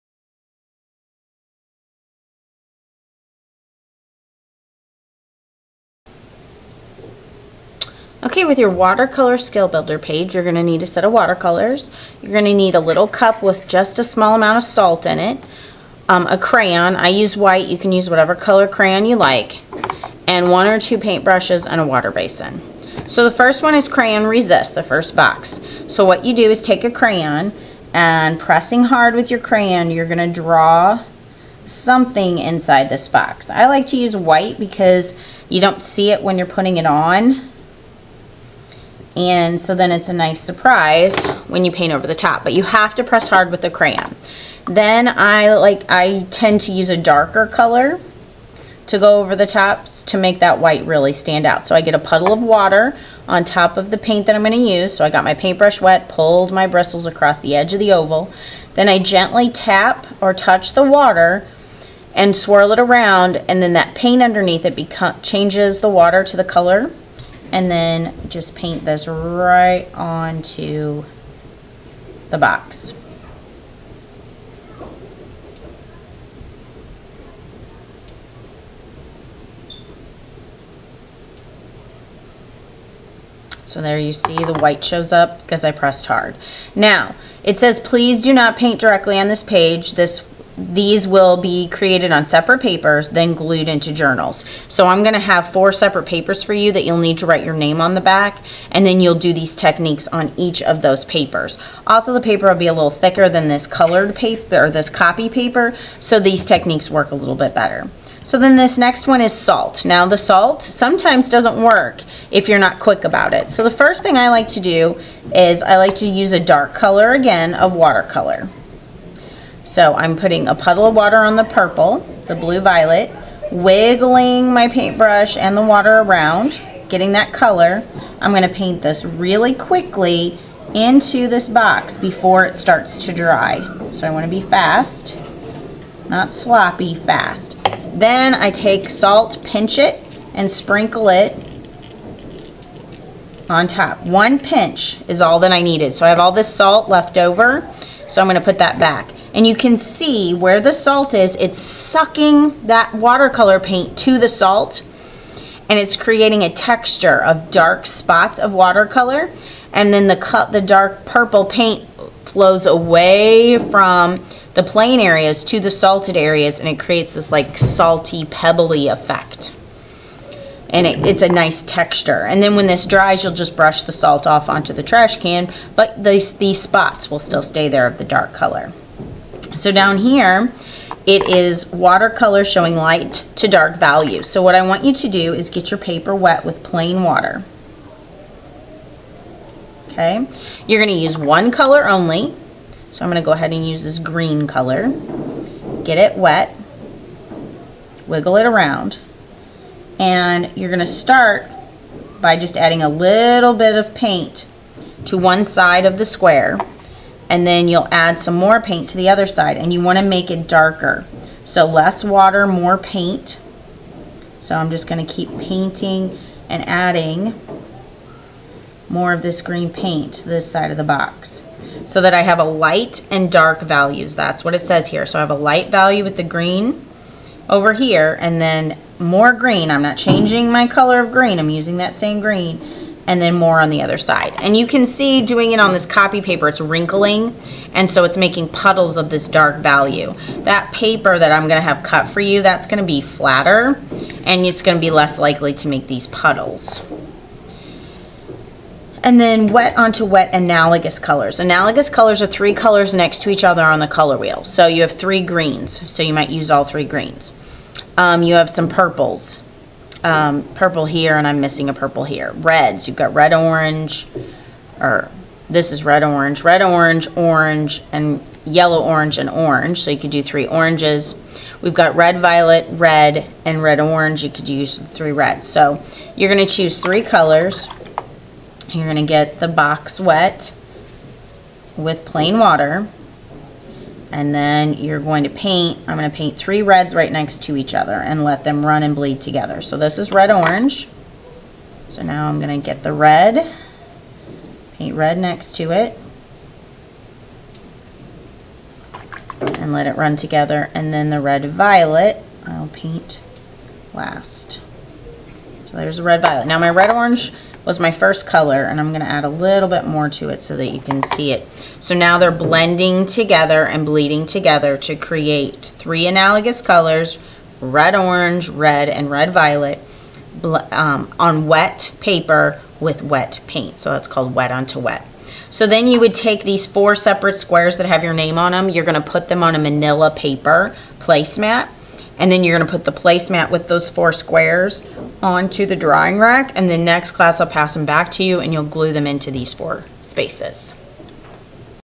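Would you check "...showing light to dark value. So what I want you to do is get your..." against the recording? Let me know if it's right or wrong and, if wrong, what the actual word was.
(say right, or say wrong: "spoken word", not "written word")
right.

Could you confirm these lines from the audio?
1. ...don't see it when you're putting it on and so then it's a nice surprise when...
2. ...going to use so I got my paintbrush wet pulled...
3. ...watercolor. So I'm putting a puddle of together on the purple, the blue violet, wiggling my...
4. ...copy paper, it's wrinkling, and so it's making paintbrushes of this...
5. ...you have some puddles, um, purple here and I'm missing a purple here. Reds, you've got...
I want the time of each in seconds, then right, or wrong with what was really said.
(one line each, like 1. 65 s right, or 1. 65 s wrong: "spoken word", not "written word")
1. 35 s right
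2. 54 s right
3. 117 s wrong: "water", not "together"
4. 235 s wrong: "puddles", not "paintbrushes"
5. 258 s wrong: "purples", not "puddles".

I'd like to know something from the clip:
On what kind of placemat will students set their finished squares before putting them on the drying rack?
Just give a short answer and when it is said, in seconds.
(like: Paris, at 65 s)
Manila paper placemat, at 329 s.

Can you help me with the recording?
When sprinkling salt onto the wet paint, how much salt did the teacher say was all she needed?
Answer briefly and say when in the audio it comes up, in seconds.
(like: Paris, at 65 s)
One pinch, at 144 s.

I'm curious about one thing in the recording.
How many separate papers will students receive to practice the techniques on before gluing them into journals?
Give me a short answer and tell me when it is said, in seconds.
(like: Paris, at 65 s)
4, at 95 s.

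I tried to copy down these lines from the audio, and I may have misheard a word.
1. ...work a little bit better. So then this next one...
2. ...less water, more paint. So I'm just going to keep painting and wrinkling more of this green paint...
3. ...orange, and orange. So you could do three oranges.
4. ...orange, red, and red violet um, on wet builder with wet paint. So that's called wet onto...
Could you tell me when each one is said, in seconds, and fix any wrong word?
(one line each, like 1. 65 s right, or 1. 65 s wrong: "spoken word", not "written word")
1. 106 s right
2. 211 s wrong: "adding", not "wrinkling"
3. 268 s right
4. 317 s wrong: "paper", not "builder".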